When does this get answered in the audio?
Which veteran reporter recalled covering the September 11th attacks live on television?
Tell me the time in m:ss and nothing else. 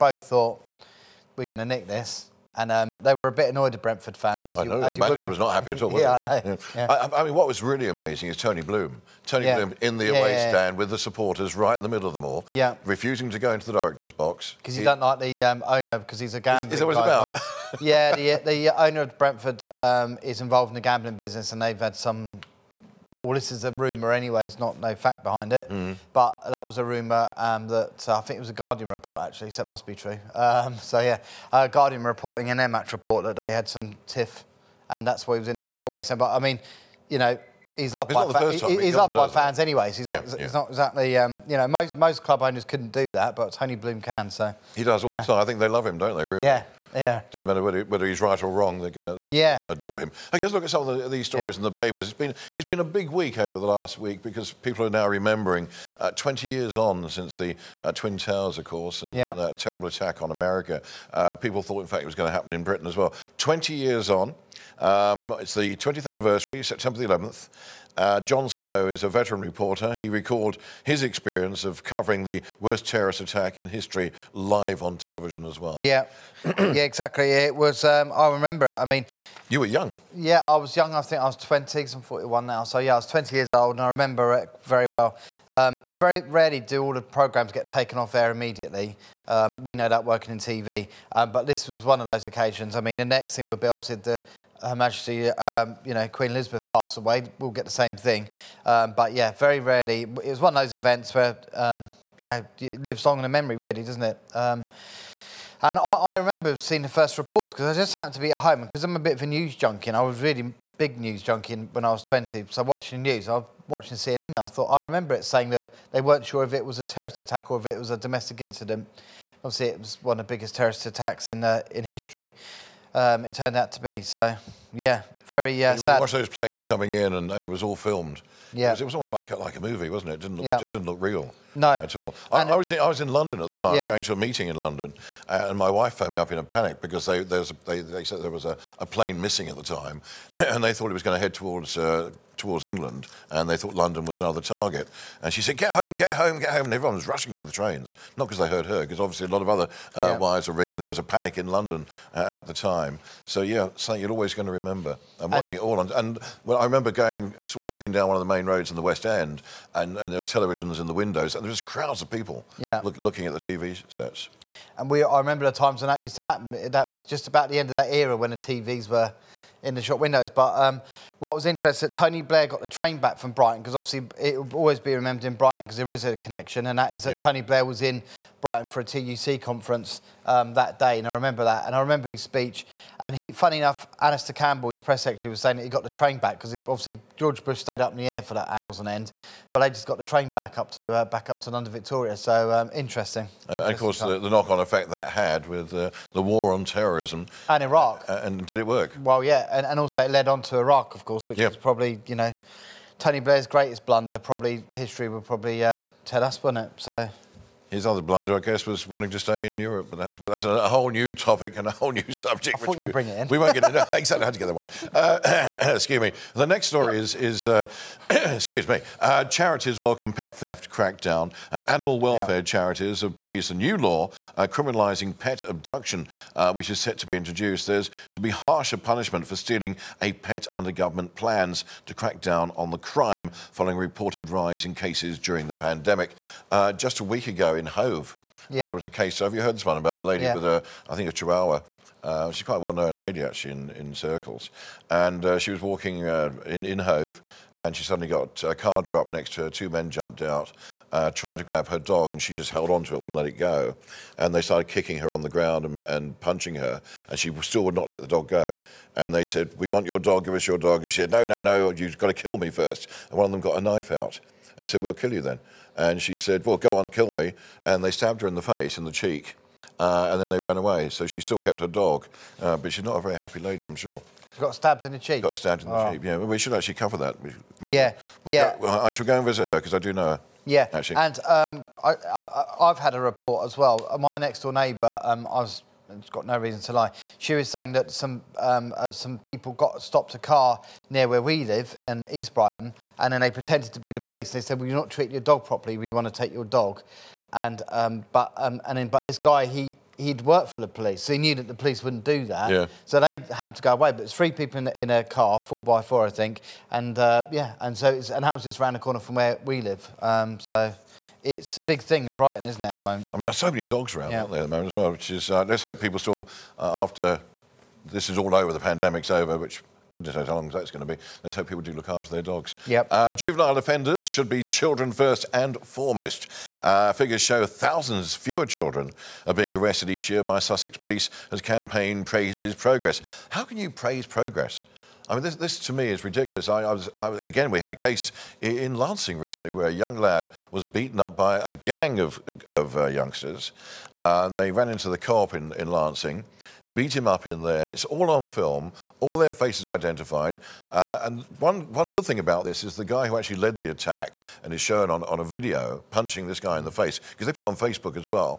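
1:08.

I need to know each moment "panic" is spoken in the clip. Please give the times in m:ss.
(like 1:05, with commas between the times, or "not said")
2:16, 2:31.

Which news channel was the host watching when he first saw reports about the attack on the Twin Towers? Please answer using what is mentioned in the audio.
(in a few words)
CNN.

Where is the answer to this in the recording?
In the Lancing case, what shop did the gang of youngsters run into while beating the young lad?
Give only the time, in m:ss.
5:44.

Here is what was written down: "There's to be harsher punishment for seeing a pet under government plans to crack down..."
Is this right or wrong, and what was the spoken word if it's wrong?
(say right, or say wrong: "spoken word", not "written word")
wrong: "stealing", not "seeing".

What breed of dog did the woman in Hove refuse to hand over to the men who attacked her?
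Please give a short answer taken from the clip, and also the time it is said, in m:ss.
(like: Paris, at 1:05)
chihuahua, at 4:01.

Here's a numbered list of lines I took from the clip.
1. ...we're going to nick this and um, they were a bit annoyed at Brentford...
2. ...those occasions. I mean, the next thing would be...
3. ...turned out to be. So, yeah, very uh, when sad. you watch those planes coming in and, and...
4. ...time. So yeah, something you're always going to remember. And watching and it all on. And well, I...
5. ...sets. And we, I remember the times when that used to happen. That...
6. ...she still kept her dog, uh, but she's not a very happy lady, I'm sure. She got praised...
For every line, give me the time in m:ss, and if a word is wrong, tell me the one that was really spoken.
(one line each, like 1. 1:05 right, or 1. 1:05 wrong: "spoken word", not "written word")
1. 0:01 right
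2. 1:32 right
3. 2:03 right
4. 2:32 right
5. 2:43 right
6. 4:31 wrong: "stabbed", not "praised".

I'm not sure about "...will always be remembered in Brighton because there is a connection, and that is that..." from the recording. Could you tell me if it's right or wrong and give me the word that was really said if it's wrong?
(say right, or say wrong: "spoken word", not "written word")
right.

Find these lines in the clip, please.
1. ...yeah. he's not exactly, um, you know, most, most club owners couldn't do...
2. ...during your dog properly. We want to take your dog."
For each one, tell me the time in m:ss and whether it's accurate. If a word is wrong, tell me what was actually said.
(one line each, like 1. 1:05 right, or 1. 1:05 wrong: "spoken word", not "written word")
1. 0:40 right
2. 4:54 wrong: "treating", not "during".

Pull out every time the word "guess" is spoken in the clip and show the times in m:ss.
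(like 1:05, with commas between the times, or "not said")
0:50, 3:28.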